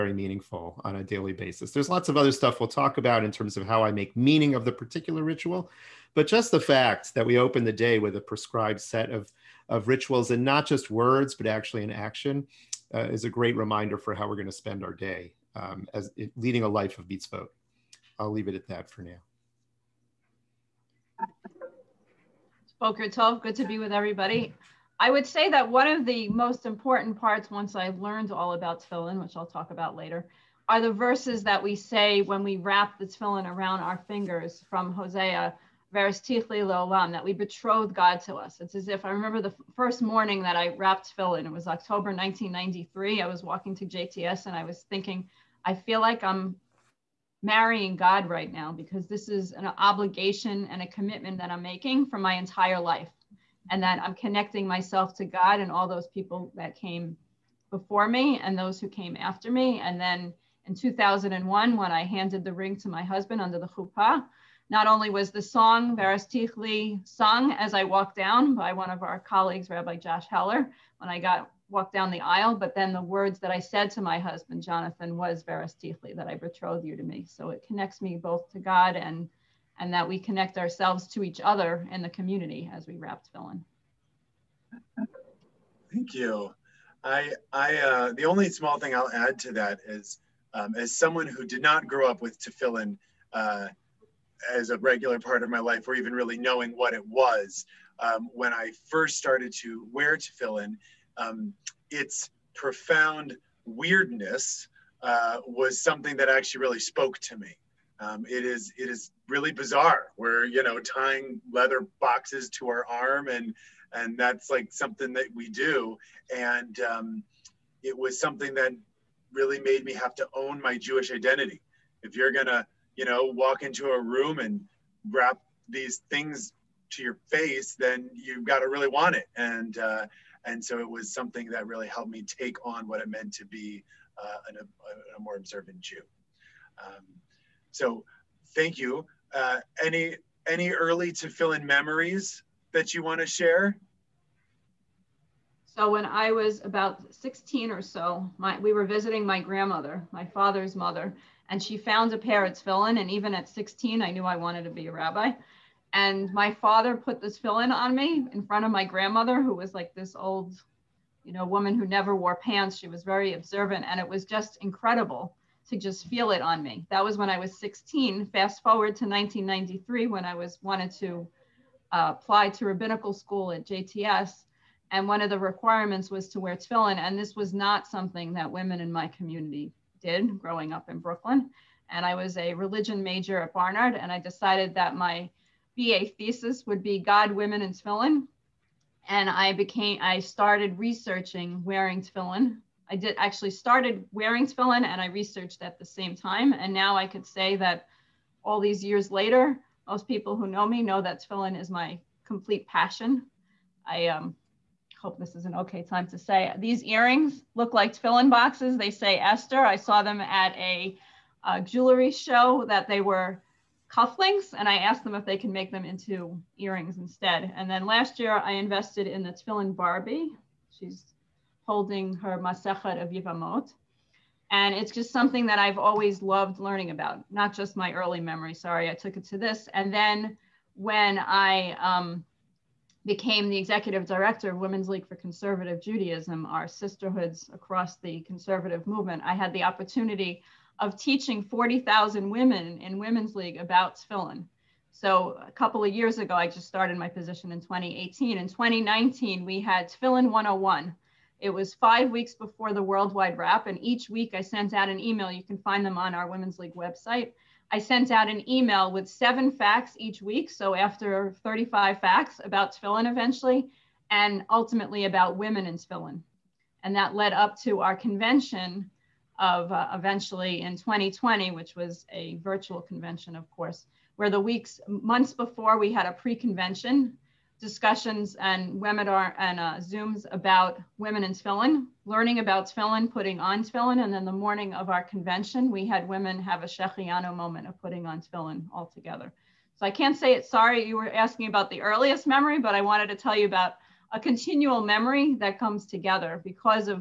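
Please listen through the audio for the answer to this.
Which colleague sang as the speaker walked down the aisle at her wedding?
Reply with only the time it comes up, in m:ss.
1:09.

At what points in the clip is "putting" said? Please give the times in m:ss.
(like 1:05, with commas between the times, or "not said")
4:43, 4:47.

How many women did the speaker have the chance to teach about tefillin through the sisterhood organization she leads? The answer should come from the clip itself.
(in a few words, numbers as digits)
40,000.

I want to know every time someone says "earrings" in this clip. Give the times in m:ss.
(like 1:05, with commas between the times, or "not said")
3:26, 3:36.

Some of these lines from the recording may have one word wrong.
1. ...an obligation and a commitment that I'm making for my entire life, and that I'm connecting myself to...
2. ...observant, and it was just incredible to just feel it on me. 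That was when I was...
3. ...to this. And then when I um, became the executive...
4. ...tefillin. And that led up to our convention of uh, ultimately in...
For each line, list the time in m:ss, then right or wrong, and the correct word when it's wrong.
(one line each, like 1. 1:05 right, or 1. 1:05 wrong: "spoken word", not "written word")
1. 0:49 right
2. 2:43 right
3. 3:49 right
4. 4:25 wrong: "eventually", not "ultimately".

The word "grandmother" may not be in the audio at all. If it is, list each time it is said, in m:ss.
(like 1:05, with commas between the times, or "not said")
2:29, 2:38.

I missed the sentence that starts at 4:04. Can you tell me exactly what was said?
So a couple of years ago, I just started my position in 2018.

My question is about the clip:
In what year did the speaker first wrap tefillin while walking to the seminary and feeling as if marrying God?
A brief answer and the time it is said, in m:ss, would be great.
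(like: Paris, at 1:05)
1993, at 0:41.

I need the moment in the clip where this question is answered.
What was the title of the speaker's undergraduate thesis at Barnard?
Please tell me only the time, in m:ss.
3:06.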